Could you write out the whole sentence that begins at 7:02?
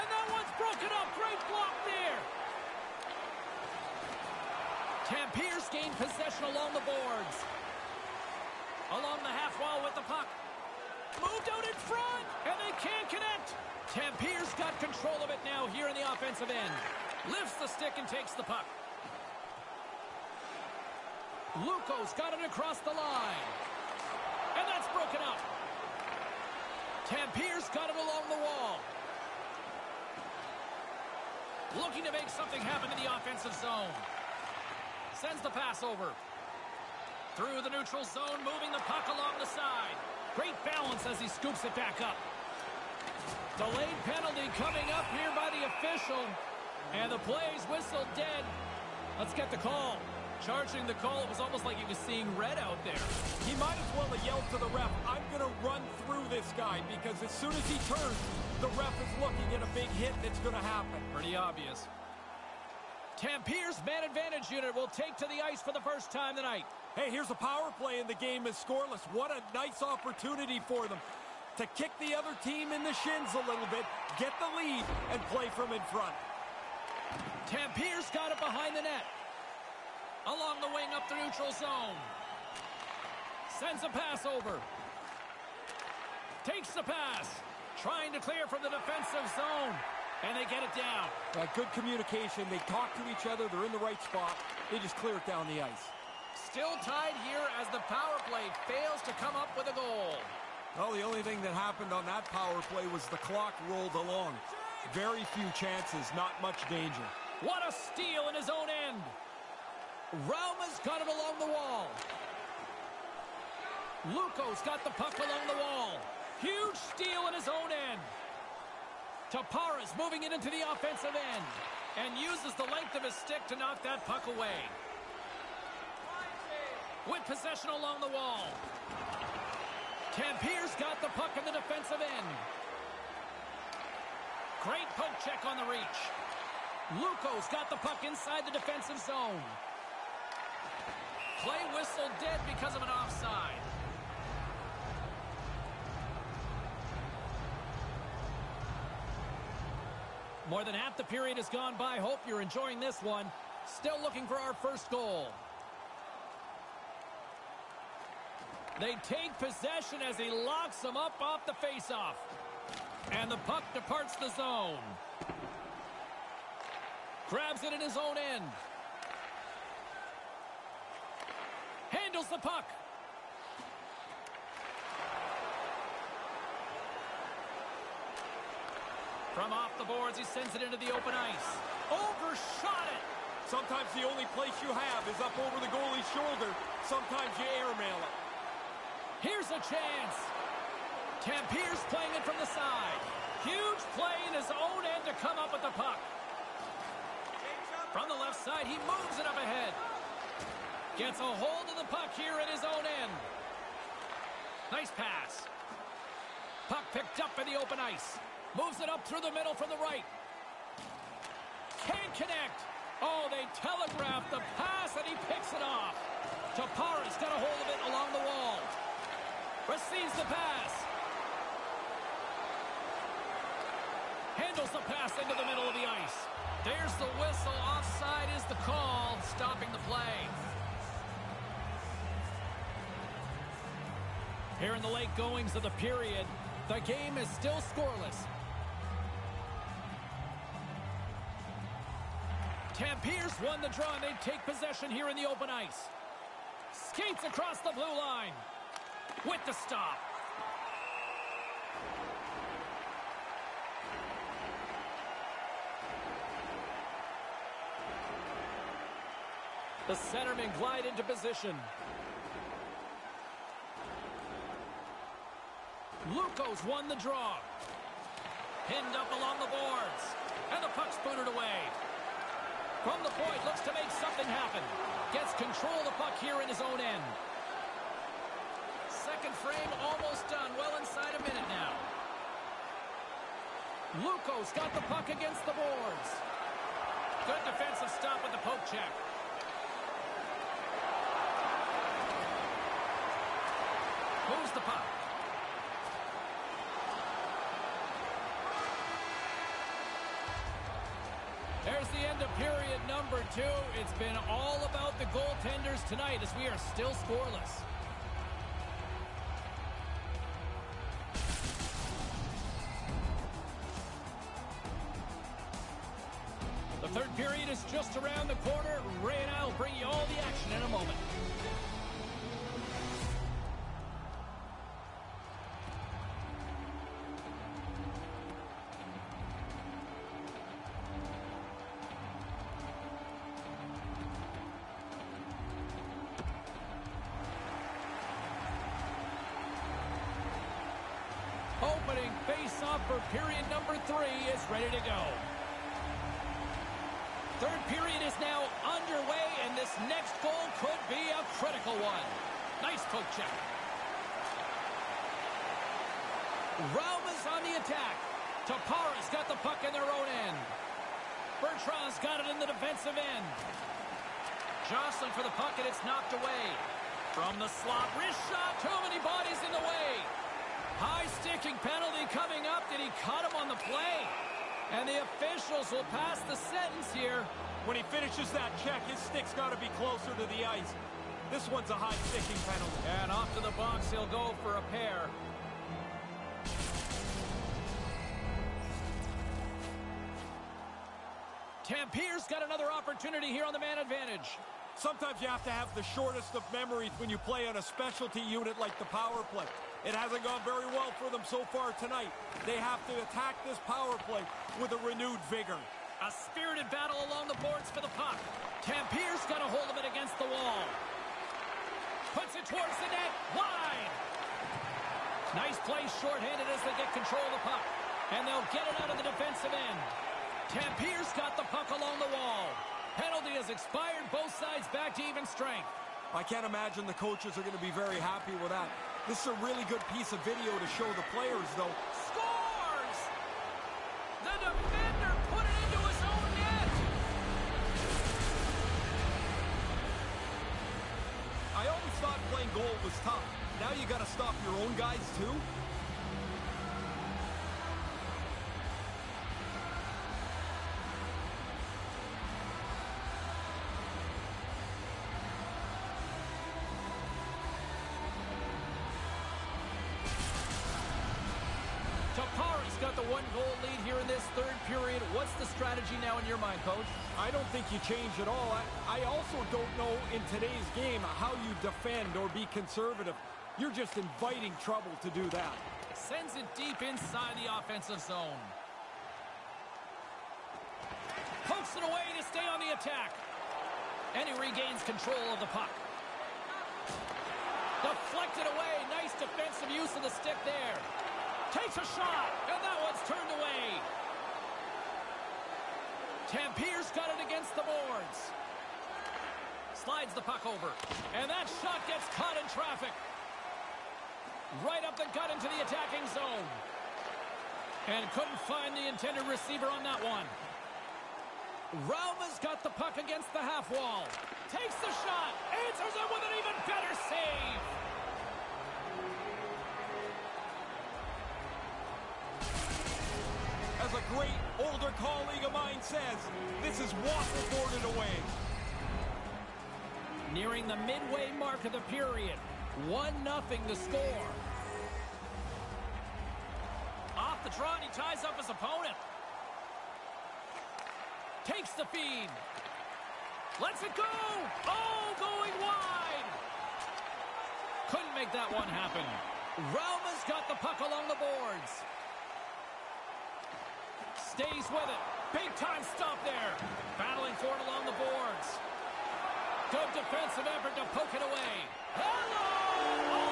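Penalty has expired, both sides back to even strength.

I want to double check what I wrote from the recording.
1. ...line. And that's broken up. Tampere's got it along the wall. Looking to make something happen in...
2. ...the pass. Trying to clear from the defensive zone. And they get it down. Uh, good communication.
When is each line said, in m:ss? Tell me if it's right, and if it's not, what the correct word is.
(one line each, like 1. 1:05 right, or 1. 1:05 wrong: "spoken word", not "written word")
1. 0:22 right
2. 1:26 right.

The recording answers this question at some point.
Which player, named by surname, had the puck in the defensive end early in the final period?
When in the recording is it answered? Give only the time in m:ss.
6:01.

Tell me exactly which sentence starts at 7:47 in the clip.
I don't think you change at all.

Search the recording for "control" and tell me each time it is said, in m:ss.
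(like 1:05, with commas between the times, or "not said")
0:14, 4:35, 6:56, 8:04.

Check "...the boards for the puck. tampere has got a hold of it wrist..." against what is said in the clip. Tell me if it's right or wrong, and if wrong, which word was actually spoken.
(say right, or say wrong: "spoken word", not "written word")
wrong: "against", not "wrist".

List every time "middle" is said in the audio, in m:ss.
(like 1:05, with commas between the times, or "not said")
3:29, 3:45.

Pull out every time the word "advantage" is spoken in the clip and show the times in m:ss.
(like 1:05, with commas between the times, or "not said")
1:04, 6:33.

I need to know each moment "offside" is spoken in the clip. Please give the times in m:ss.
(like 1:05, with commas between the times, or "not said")
2:22, 3:47.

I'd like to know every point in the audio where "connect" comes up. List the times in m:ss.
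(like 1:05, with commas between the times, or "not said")
0:13, 3:32.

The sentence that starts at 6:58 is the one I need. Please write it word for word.
And they'll get it out of the defensive end.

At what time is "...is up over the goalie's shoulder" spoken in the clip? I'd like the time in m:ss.
3:05.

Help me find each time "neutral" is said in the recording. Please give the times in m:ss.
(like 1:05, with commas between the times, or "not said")
0:37, 1:21.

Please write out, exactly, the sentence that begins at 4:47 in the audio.
Good defensive stop with the poke check.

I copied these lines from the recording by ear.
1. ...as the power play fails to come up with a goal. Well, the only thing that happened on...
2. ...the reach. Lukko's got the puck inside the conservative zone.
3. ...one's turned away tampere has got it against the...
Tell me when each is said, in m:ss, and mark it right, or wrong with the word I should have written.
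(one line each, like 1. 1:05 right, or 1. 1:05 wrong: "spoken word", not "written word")
1. 1:37 right
2. 2:15 wrong: "defensive", not "conservative"
3. 8:12 right.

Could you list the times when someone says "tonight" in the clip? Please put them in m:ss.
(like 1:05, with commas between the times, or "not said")
1:06, 5:05, 6:41.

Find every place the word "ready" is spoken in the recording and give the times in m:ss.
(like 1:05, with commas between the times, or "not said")
5:44.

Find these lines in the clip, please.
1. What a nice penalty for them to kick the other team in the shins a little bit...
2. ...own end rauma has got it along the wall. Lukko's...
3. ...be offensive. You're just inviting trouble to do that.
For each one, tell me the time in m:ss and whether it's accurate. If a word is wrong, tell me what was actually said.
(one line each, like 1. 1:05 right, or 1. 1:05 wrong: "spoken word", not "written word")
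1. 1:09 wrong: "opportunity", not "penalty"
2. 1:48 right
3. 7:52 wrong: "conservative", not "offensive".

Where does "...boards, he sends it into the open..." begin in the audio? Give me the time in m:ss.
2:59.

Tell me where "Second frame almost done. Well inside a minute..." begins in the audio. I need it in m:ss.
4:38.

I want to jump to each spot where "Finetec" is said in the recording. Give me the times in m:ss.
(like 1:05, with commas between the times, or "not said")
not said.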